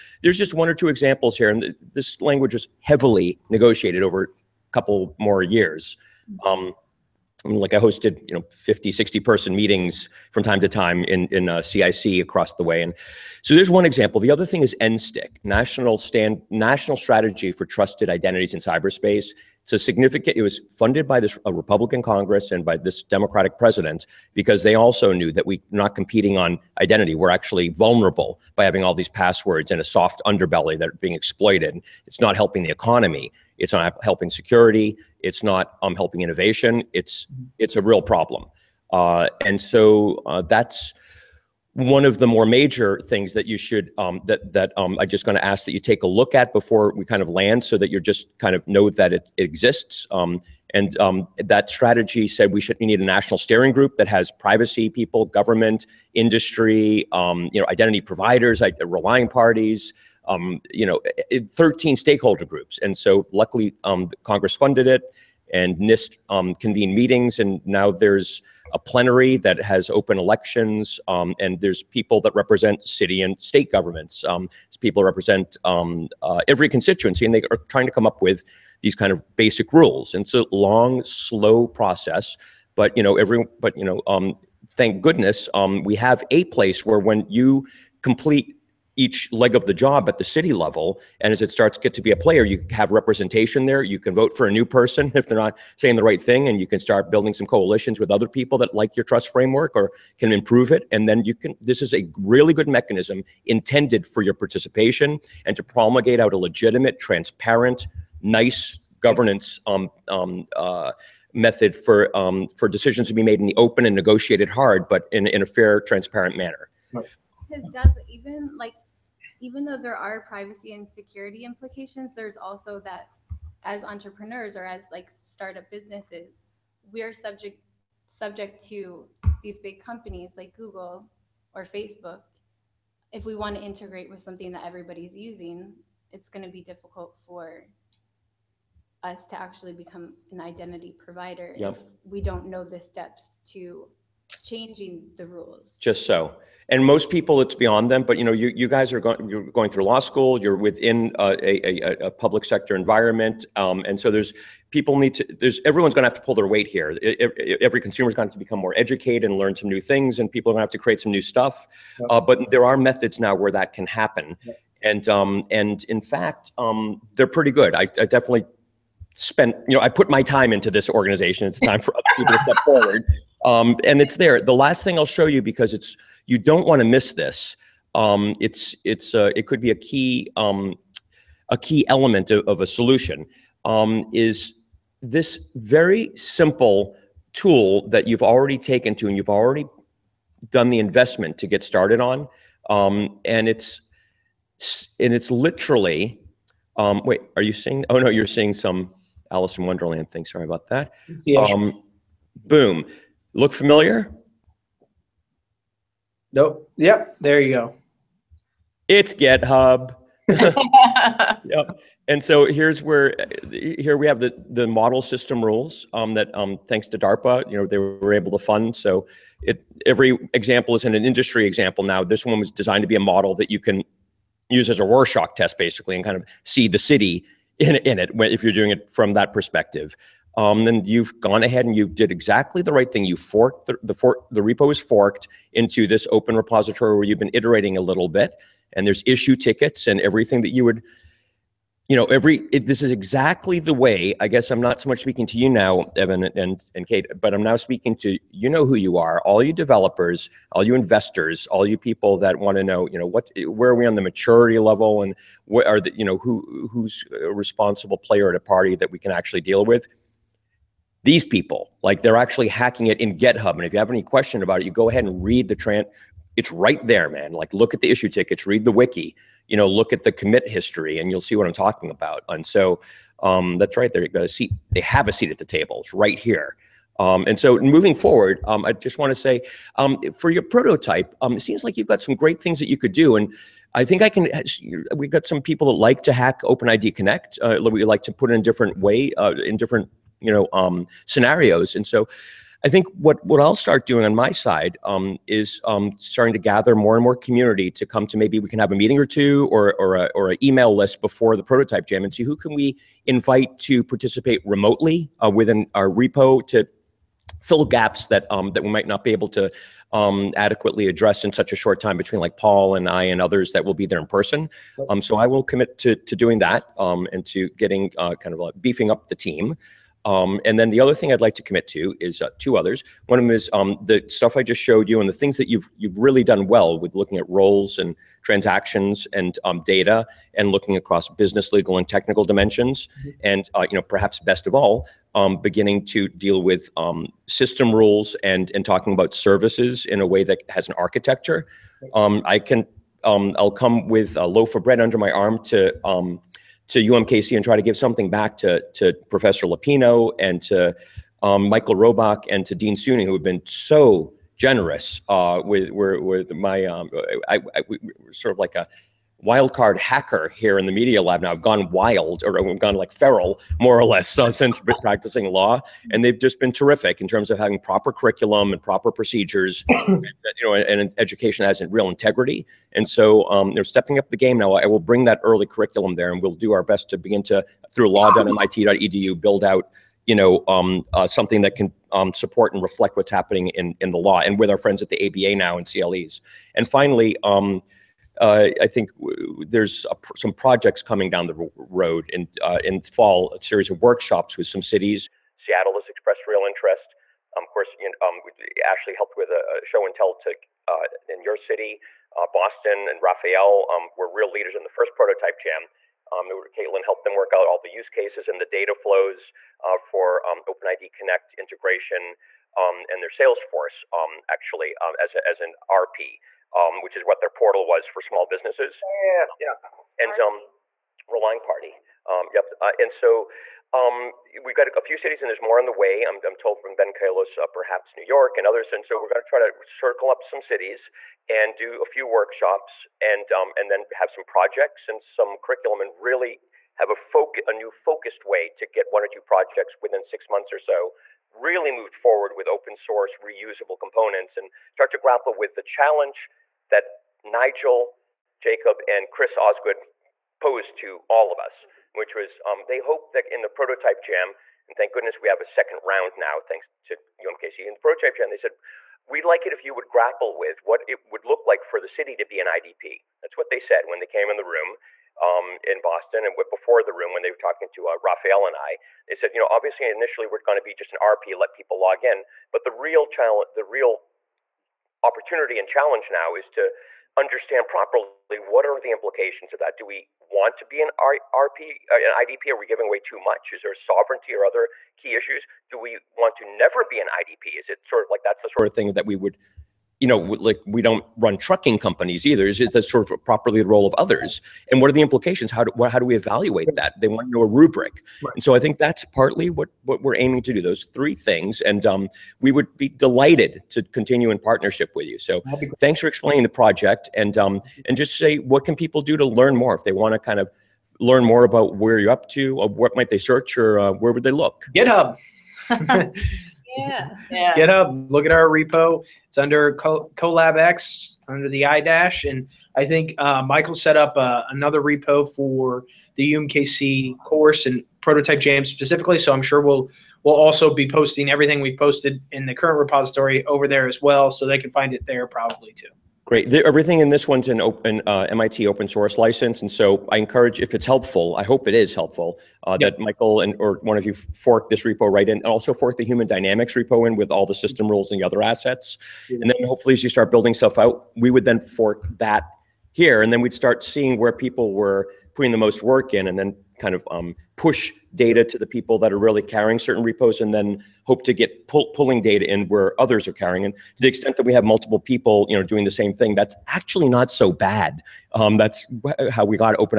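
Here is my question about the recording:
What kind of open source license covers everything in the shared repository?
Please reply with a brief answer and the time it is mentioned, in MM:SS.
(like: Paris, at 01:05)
MIT open source license, at 08:58.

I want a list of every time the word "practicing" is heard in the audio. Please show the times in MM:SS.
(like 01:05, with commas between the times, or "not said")
06:04.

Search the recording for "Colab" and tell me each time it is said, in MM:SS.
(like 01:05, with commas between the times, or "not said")
08:40.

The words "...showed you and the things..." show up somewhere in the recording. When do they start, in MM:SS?
05:24.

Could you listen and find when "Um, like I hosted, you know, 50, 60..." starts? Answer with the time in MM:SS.
00:06.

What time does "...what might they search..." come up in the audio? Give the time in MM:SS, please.
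08:32.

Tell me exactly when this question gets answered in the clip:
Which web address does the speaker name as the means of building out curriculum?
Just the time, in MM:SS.
06:17.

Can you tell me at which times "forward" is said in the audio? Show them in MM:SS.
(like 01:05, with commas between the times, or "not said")
02:52, 04:37, 07:21.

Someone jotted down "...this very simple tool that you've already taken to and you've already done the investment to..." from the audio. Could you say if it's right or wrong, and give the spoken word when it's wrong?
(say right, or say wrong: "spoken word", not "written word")
right.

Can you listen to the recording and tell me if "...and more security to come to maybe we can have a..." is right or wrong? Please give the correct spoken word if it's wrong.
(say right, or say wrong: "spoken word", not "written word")
wrong: "community", not "security".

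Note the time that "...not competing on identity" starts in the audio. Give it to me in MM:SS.
00:25.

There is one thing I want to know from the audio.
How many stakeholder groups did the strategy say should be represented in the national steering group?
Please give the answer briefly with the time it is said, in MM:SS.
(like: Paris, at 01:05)
13, at 01:01.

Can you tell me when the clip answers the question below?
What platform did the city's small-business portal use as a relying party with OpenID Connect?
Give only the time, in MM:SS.
06:53.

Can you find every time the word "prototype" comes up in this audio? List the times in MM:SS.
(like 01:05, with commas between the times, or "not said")
04:40, 05:01, 06:44, 07:33, 07:37, 08:48.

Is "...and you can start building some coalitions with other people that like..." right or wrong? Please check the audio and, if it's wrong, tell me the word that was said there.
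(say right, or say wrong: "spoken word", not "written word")
right.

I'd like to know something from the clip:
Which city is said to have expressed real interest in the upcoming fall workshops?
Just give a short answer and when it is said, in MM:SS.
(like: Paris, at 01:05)
Seattle, at 06:35.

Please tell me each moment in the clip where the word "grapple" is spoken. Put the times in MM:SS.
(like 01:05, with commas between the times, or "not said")
07:24, 07:39.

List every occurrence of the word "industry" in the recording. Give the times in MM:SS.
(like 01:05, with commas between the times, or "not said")
00:56, 03:41.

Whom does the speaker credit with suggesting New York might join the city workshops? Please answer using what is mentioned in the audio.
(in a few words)
Ben Kallos.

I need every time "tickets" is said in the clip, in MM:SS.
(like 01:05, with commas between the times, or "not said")
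03:59, 04:28.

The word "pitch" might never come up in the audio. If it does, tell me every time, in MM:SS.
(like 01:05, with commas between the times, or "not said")
not said.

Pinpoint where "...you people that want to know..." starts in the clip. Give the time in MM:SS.
04:11.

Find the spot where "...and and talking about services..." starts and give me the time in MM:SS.
05:38.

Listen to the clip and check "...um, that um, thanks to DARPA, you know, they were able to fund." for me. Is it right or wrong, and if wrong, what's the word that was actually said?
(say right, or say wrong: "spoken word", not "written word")
right.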